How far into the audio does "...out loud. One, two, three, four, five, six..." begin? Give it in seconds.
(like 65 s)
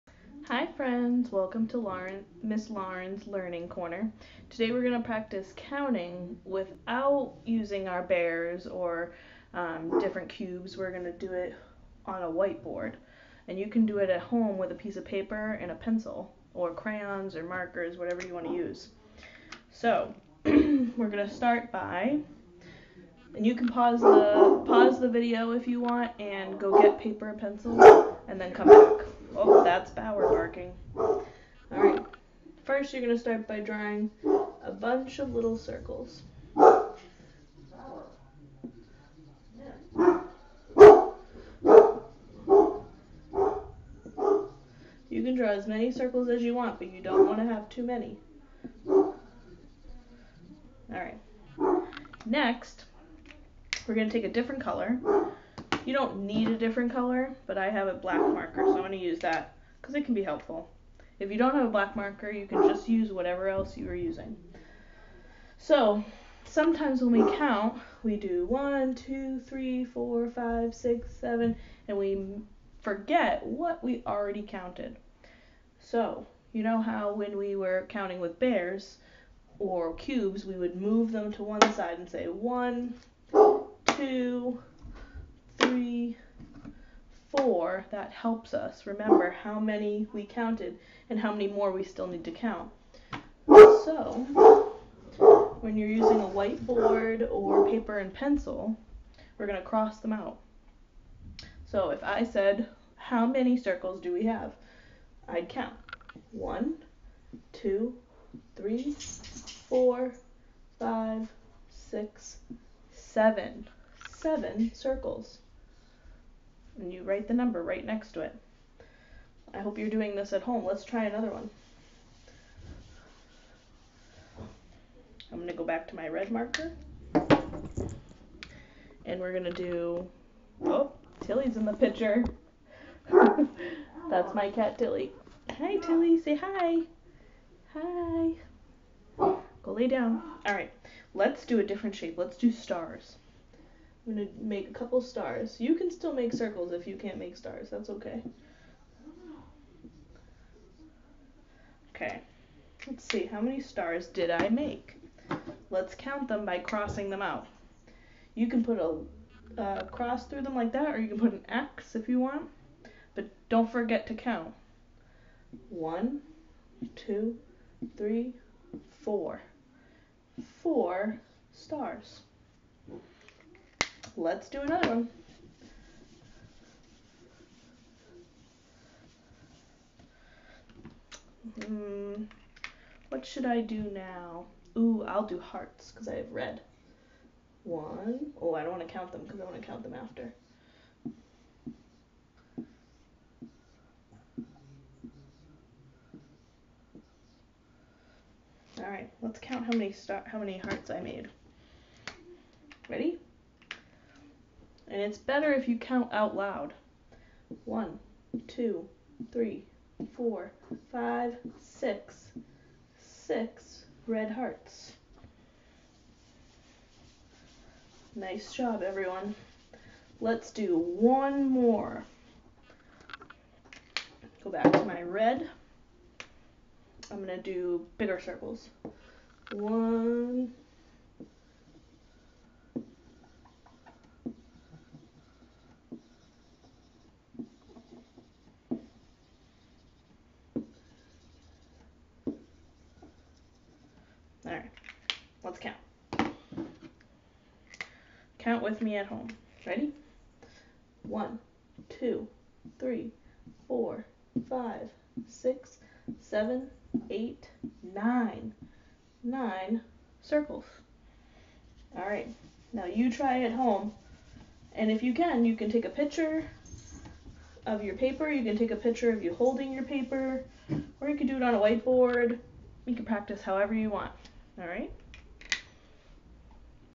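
206 s.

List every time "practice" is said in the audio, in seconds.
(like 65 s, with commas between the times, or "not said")
5 s, 273 s.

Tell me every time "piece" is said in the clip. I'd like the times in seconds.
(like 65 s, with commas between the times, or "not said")
14 s.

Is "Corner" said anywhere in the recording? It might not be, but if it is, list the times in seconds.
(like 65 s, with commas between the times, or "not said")
3 s.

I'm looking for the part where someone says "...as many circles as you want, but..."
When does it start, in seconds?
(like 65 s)
45 s.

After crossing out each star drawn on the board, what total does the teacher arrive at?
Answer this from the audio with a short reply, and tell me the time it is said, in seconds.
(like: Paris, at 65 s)
4, at 170 s.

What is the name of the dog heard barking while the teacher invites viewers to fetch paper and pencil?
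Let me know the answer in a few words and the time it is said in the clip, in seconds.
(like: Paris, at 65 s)
Bower, at 29 s.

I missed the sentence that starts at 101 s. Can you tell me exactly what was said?
So if I said, how many circles do we have?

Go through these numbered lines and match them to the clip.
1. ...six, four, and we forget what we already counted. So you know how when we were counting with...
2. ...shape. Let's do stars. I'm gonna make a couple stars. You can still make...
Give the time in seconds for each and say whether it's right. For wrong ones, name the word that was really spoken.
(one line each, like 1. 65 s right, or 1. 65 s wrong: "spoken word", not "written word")
1. 70 s wrong: "seven", not "four"
2. 141 s right.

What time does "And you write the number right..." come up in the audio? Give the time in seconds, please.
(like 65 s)
116 s.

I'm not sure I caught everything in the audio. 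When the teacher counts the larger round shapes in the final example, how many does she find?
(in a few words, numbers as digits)
9.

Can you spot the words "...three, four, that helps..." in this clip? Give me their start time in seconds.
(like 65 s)
85 s.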